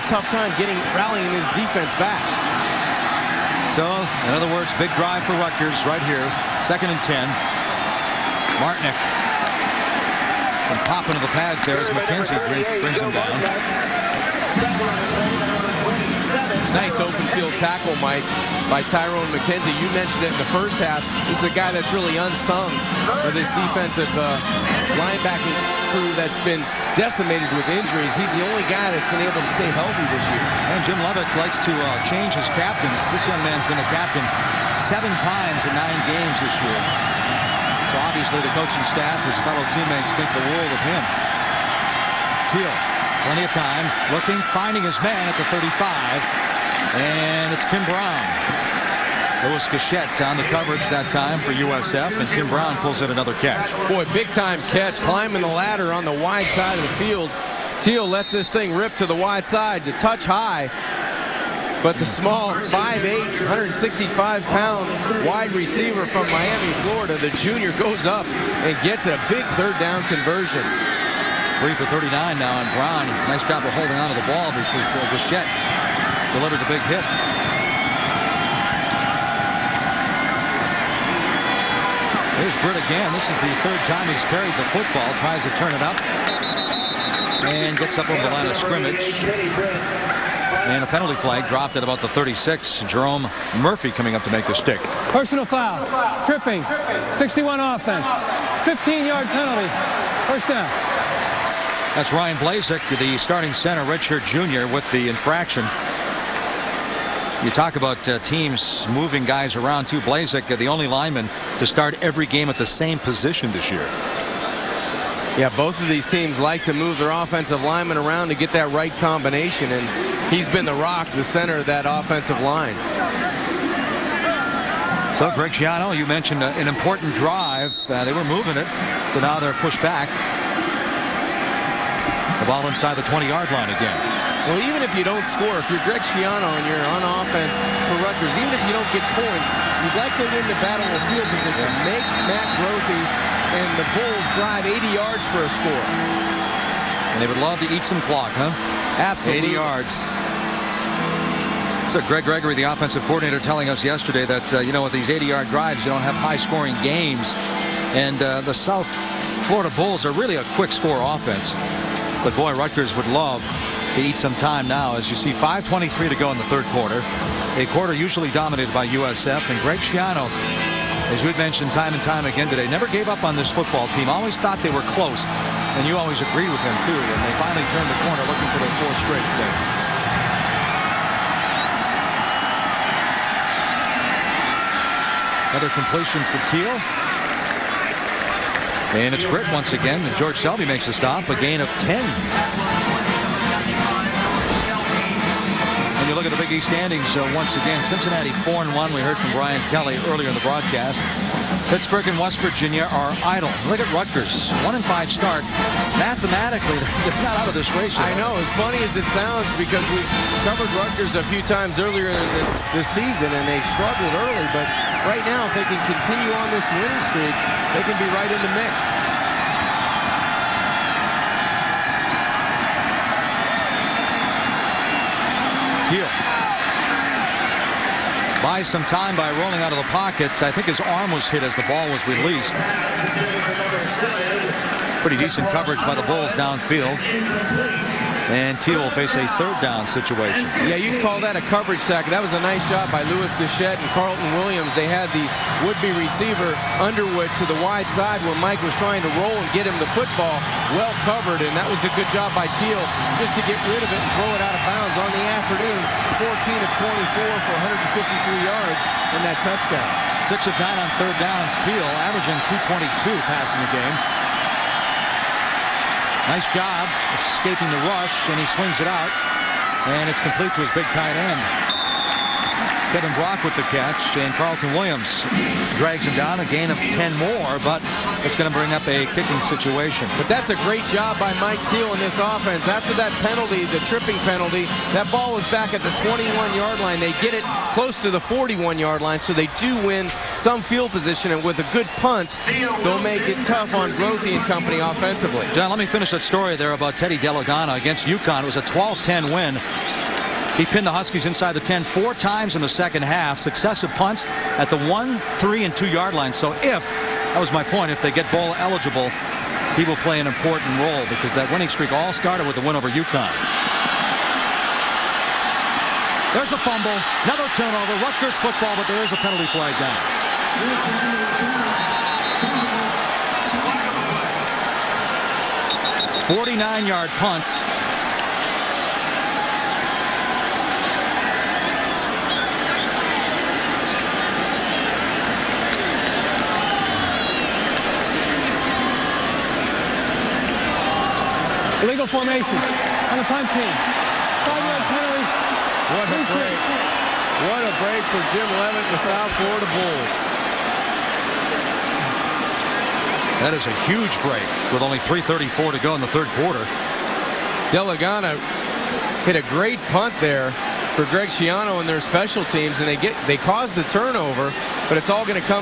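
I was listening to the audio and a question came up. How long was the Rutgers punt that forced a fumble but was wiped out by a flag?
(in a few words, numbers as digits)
49 yards.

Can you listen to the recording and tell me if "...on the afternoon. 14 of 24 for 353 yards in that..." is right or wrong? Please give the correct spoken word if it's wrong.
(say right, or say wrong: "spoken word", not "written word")
wrong: "153", not "353".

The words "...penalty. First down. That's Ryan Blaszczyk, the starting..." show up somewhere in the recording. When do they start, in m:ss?
1:39.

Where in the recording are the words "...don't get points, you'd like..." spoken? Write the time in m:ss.
2:18.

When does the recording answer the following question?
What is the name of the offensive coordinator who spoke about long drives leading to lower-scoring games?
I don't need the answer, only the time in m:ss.
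2:32.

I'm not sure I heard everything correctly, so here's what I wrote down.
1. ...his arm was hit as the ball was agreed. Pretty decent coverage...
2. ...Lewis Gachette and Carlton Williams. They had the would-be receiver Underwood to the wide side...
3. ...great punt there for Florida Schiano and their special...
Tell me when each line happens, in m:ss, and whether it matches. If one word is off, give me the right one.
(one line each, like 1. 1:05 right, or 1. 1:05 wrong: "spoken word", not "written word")
1. 3:50 wrong: "released", not "agreed"
2. 4:03 right
3. 5:59 wrong: "Greg", not "Florida".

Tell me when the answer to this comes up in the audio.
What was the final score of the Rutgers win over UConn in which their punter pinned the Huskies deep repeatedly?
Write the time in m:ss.
4:58.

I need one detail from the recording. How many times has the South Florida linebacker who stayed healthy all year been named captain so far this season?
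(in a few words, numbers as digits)
7.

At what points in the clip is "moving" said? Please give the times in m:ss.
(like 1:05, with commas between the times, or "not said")
1:48, 2:08.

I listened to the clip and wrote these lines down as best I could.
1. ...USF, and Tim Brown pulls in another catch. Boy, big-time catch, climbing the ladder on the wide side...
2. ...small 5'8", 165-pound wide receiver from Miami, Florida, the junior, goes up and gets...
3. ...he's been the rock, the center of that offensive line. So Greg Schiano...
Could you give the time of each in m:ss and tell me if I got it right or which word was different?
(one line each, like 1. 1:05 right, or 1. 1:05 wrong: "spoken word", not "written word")
1. 0:51 right
2. 1:02 right
3. 2:00 right.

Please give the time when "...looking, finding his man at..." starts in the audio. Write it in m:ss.
0:44.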